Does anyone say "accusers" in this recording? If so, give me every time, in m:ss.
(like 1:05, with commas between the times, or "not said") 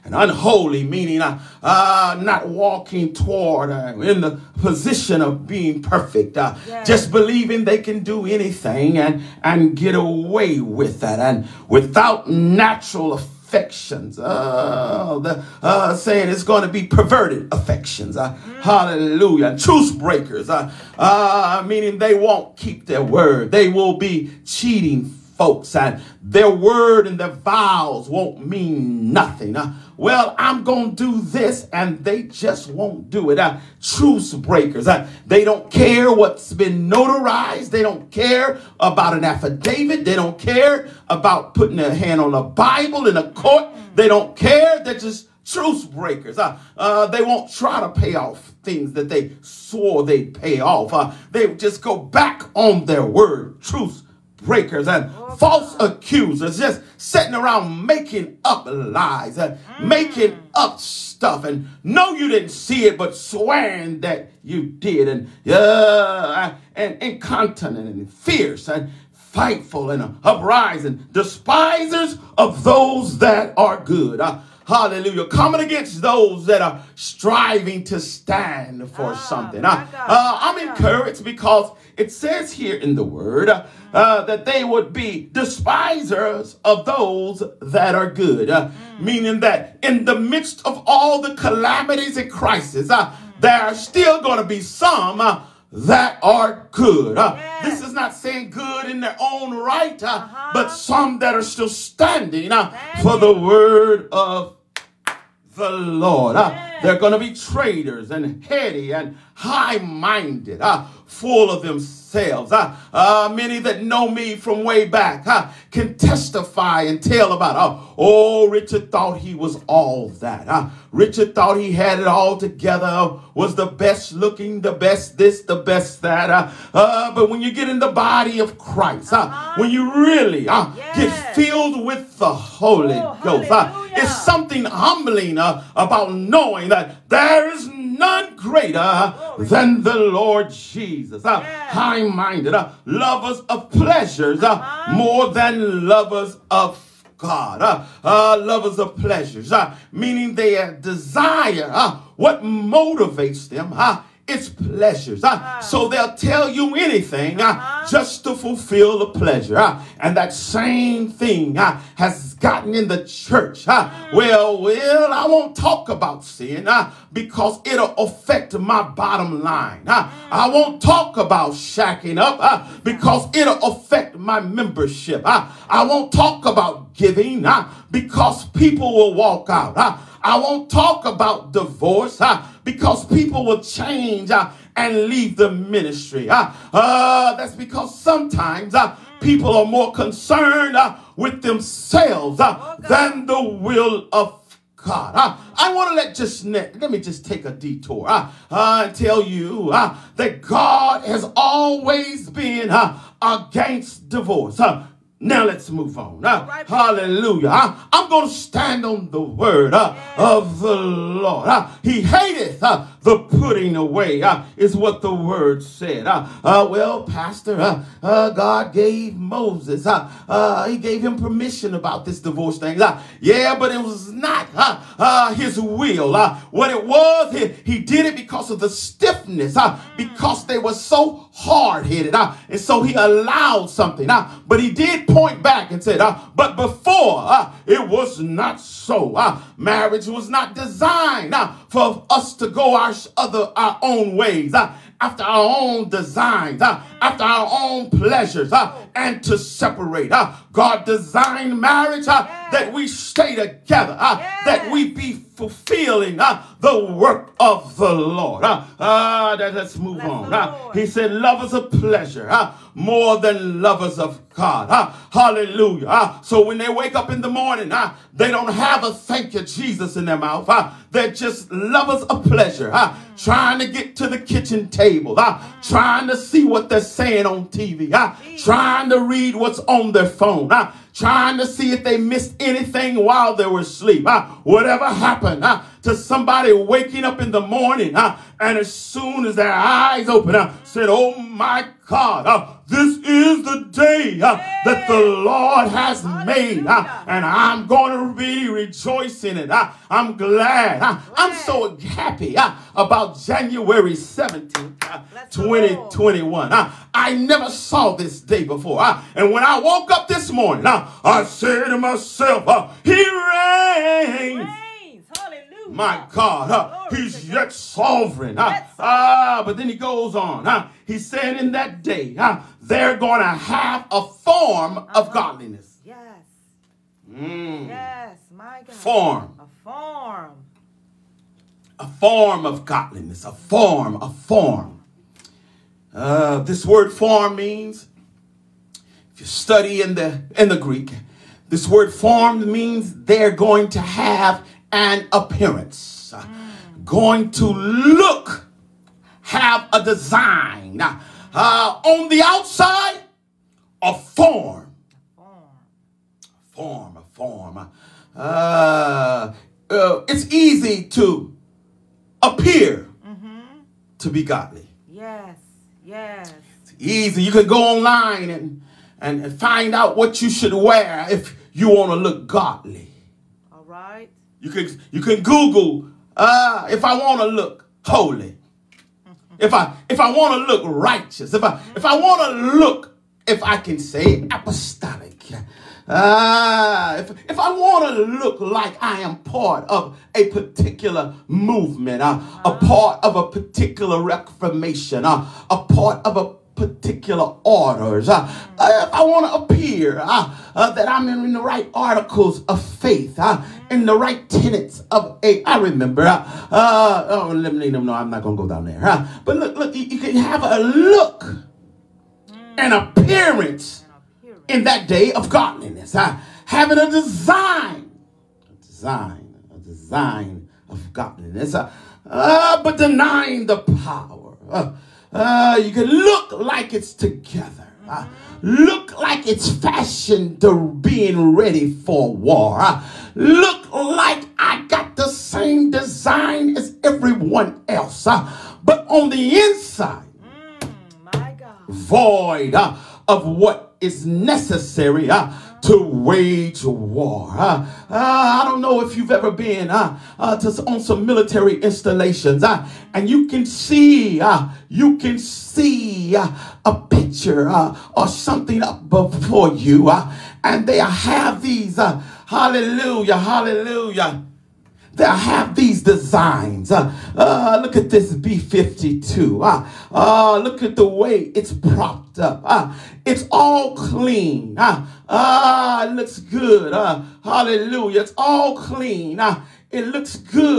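0:55.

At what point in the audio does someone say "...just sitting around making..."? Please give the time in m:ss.
0:56.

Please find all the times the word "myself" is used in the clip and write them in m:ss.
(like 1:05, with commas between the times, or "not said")
5:11.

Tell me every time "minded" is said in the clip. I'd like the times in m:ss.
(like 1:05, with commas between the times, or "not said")
1:49, 2:22.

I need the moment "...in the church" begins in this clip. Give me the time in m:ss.
2:42.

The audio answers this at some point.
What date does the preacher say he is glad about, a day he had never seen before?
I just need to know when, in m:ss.
5:03.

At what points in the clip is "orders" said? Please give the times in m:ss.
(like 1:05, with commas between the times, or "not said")
6:37.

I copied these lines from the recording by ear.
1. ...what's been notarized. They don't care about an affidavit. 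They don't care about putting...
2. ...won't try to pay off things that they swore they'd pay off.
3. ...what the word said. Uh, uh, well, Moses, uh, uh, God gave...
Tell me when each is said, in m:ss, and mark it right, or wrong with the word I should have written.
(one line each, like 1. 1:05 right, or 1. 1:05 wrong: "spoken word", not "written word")
1. 0:36 right
2. 0:47 right
3. 3:34 wrong: "Pastor", not "Moses".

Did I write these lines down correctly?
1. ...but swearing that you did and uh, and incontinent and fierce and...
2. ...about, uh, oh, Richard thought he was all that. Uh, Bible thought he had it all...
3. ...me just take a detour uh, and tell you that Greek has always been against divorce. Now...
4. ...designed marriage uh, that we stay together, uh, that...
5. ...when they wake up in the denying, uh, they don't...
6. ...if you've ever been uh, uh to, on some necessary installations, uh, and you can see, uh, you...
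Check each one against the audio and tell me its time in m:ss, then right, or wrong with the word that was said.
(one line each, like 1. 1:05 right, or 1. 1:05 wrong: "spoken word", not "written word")
1. 1:02 right
2. 1:57 wrong: "Richard", not "Bible"
3. 3:16 wrong: "God", not "Greek"
4. 4:10 right
5. 4:26 wrong: "morning", not "denying"
6. 7:28 wrong: "military", not "necessary".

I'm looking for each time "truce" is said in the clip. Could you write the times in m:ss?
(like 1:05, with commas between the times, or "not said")
0:33, 0:45, 0:53.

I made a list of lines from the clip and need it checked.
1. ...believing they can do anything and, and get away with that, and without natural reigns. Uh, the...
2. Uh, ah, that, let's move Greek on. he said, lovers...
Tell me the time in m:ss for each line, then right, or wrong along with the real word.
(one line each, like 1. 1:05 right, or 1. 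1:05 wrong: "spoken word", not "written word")
1. 0:07 wrong: "affections", not "reigns"
2. 4:18 wrong: "Bless", not "Greek".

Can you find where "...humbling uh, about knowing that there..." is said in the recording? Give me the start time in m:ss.
2:14.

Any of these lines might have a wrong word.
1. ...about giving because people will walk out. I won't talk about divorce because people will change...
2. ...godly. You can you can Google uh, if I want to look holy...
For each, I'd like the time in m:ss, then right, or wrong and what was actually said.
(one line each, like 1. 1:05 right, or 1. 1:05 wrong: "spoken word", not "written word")
1. 2:56 right
2. 6:12 right.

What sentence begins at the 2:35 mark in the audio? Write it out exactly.
Uh, so they'll tell you anything uh, just to fulfill the pleasure.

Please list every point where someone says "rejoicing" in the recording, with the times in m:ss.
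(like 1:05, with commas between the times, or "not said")
4:58.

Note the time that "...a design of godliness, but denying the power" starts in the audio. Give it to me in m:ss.
6:59.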